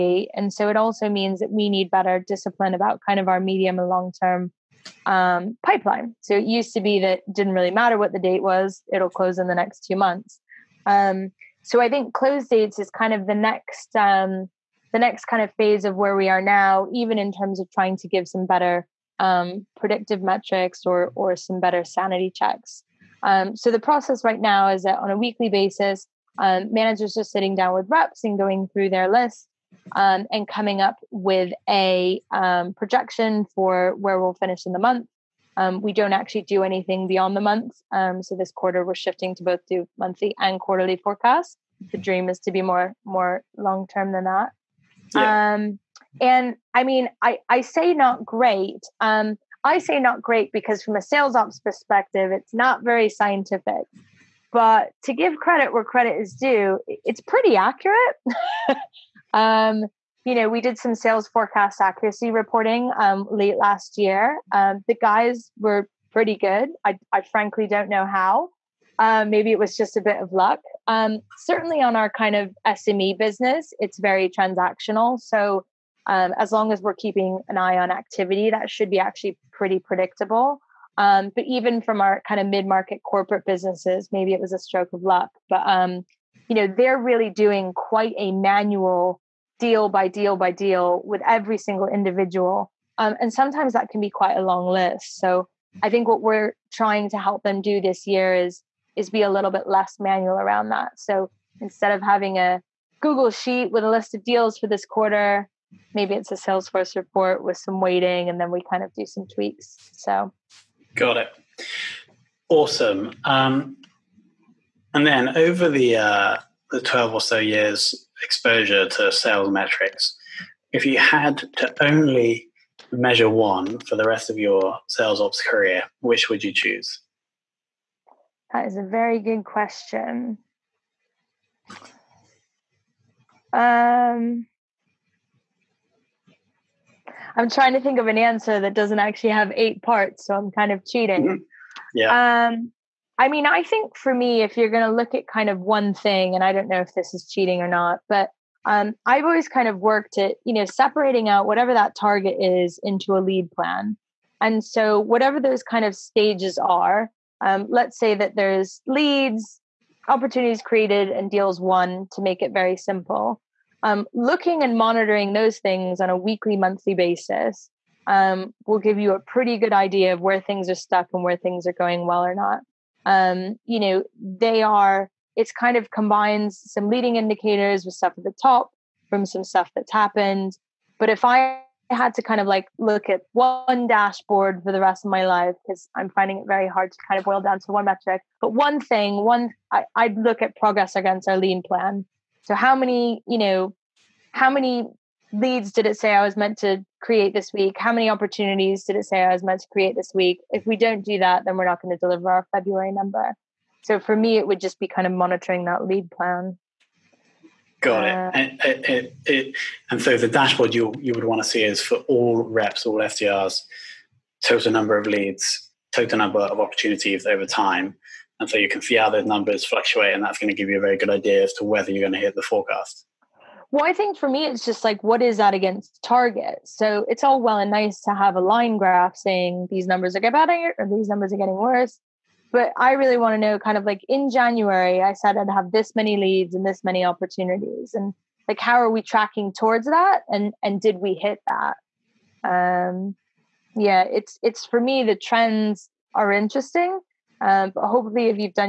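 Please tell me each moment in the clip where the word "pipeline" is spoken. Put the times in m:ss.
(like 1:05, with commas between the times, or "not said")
0:05.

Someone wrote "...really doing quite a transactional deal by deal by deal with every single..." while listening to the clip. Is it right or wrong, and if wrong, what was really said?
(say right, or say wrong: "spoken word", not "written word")
wrong: "manual", not "transactional".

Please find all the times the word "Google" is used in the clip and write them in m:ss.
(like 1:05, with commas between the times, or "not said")
1:43.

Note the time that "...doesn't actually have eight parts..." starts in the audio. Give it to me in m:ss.
2:18.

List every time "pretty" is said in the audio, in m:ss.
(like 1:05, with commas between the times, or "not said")
0:57, 1:06, 1:19, 2:49.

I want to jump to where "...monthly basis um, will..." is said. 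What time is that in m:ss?
2:46.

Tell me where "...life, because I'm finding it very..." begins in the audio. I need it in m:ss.
3:05.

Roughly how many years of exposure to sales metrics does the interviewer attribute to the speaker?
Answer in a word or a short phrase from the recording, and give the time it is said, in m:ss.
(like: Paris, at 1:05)
12, at 1:56.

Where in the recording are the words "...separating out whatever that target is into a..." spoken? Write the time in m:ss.
2:30.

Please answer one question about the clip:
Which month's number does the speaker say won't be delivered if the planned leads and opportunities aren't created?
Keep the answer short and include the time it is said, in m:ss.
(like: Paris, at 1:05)
February, at 3:22.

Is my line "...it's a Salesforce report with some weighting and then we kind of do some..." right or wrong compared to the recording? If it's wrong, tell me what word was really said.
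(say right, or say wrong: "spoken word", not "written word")
right.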